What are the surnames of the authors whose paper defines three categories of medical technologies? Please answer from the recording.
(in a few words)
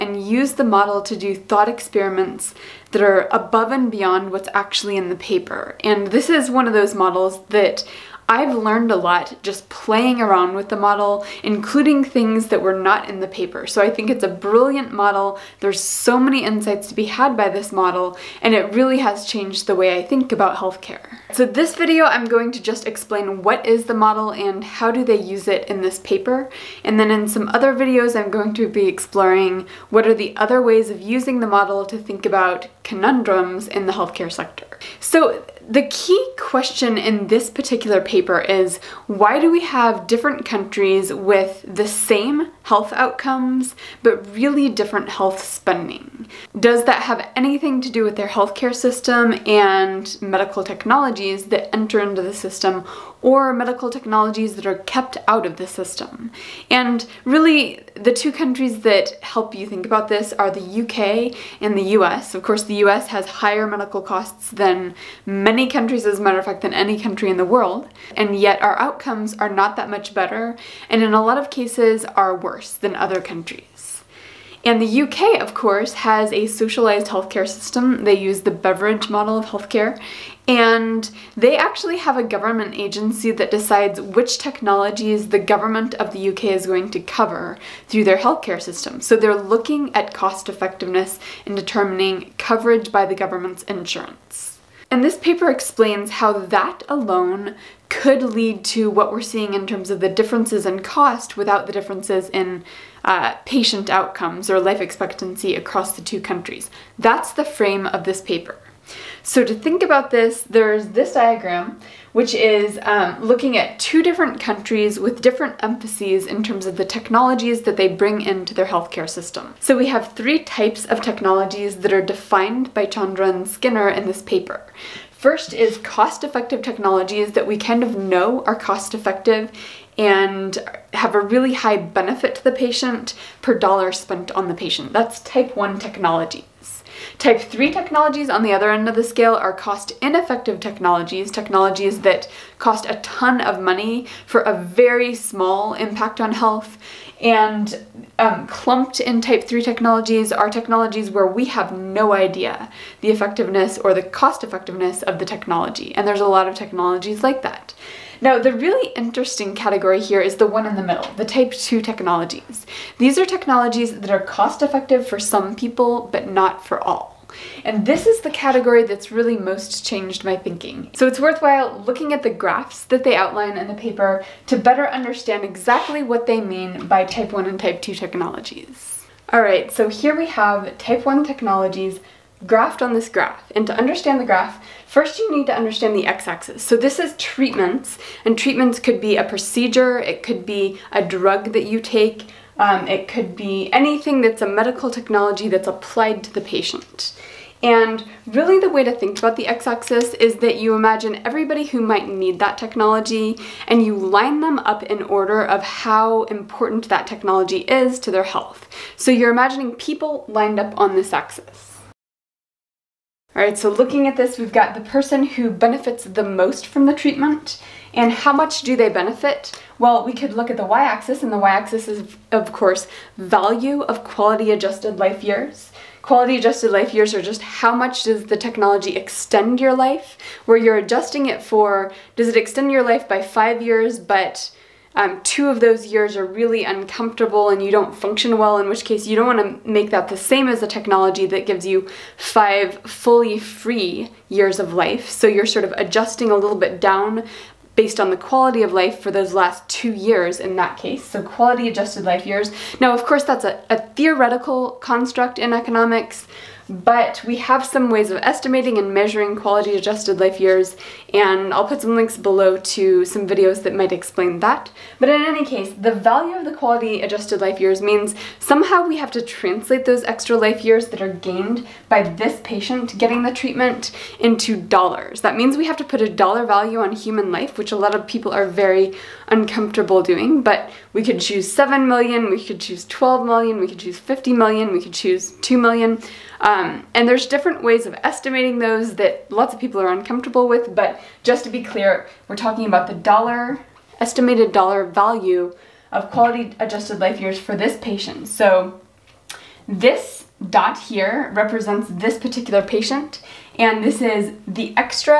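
Chandra and Skinner.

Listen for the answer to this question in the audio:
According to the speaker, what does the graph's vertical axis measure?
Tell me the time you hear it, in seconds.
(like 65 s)
223 s.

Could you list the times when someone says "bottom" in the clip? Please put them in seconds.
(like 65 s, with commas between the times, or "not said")
not said.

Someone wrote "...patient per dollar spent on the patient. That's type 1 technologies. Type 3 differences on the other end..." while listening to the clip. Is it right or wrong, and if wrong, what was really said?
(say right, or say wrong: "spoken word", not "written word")
wrong: "technologies", not "differences".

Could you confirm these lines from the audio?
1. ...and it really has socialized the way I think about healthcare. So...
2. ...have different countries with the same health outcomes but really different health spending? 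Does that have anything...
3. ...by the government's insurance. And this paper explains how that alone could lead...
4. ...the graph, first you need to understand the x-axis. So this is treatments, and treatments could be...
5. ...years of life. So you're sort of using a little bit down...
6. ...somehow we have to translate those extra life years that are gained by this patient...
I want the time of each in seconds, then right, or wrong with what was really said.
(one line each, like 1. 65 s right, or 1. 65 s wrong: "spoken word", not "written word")
1. 18 s wrong: "changed", not "socialized"
2. 39 s right
3. 92 s right
4. 184 s right
5. 244 s wrong: "adjusting", not "using"
6. 268 s right.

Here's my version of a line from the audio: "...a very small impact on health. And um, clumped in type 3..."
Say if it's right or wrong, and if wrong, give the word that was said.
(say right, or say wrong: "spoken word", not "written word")
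right.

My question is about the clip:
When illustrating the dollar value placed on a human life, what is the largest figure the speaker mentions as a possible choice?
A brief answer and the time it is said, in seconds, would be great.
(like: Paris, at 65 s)
50 million, at 283 s.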